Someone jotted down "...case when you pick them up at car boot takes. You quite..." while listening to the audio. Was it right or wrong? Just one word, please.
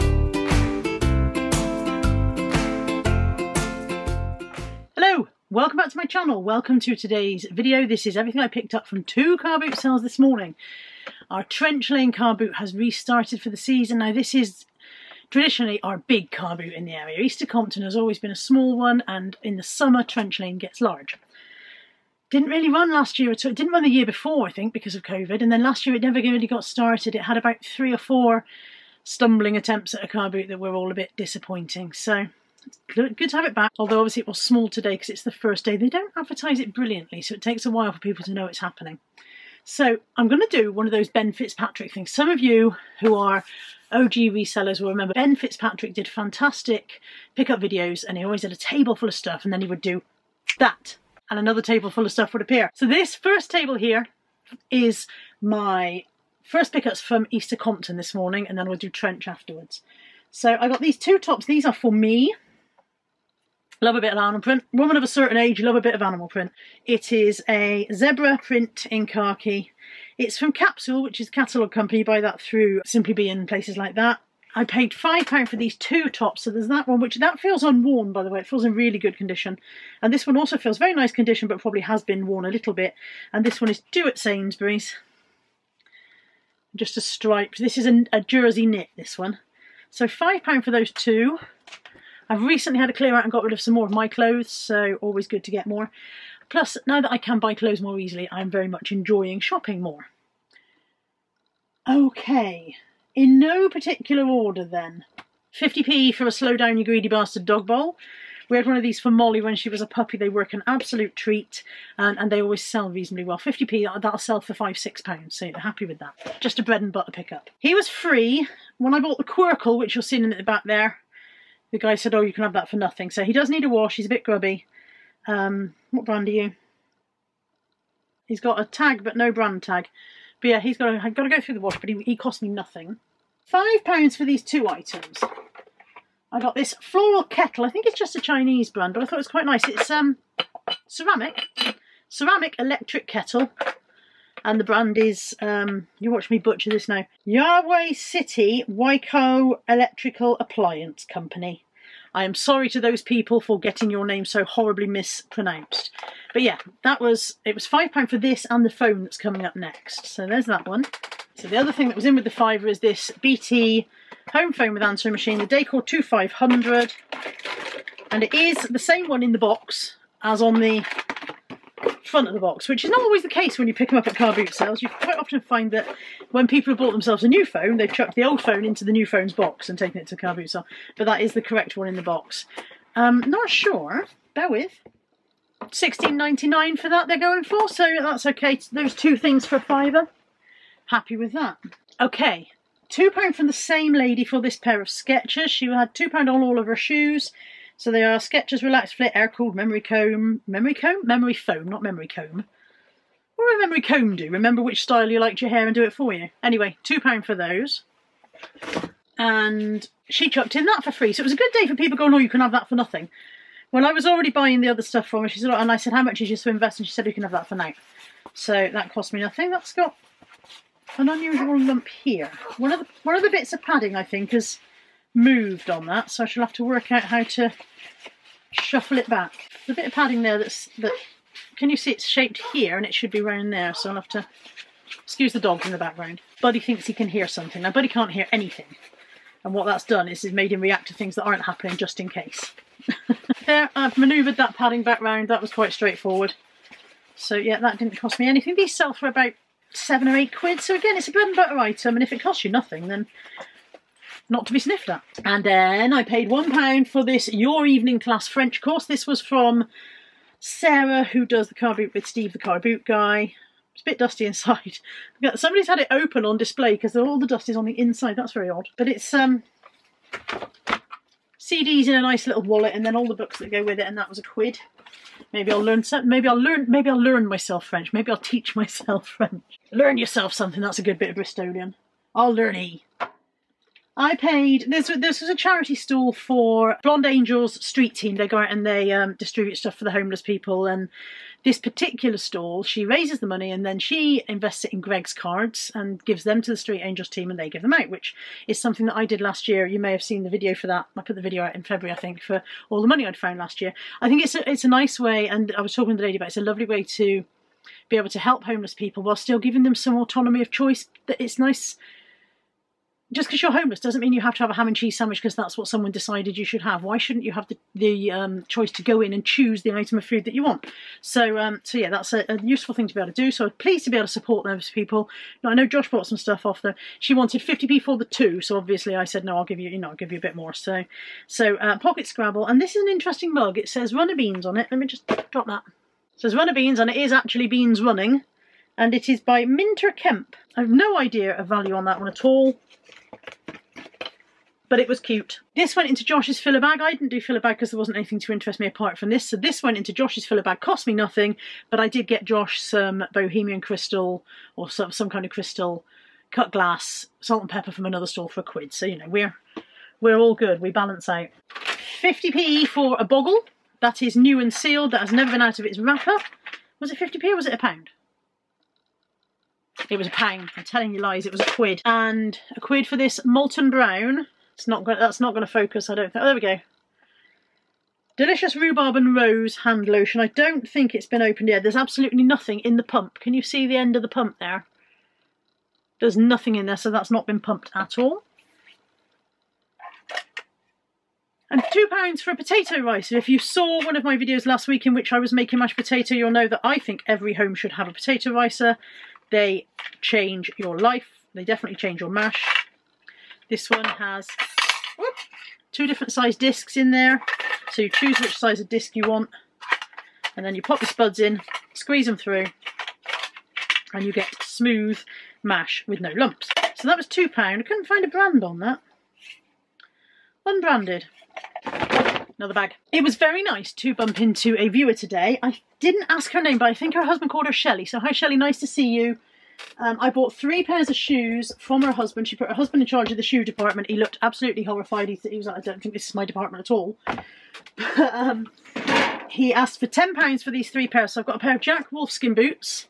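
wrong.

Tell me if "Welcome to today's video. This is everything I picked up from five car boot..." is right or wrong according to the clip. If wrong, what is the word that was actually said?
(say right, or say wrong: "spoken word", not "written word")
wrong: "two", not "five".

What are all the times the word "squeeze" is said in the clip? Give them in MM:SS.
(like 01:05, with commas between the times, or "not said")
06:51.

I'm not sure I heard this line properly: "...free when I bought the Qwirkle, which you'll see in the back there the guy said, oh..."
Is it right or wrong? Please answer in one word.
right.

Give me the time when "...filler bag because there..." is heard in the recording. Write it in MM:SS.
05:47.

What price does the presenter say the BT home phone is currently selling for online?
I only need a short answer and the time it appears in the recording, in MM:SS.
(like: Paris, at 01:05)
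£16.99, at 03:05.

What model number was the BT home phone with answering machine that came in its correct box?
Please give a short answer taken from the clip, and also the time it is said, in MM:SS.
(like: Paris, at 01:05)
2500, at 02:45.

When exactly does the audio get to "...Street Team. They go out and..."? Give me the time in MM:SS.
04:47.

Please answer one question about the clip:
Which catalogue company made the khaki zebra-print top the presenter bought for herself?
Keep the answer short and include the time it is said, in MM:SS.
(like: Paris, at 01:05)
Capsule, at 01:10.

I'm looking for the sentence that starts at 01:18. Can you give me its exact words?
It feels in really good condition.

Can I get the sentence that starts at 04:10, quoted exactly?
So again, it's a bread and butter item.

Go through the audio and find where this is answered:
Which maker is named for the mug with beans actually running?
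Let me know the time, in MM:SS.
05:39.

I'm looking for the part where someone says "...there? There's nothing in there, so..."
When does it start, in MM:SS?
06:24.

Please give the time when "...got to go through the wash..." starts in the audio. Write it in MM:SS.
02:11.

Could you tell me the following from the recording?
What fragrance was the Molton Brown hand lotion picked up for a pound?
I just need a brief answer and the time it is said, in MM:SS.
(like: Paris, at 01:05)
Rhubarb and rose, at 06:18.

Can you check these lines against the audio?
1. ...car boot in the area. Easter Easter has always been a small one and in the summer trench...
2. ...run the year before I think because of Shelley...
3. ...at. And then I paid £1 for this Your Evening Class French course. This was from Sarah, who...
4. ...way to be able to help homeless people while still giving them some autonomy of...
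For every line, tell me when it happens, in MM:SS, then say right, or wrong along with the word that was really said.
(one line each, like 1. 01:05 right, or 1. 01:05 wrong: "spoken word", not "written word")
1. 00:16 wrong: "Compton", not "Easter"
2. 00:23 wrong: "Covid", not "Shelley"
3. 04:14 right
4. 05:06 right.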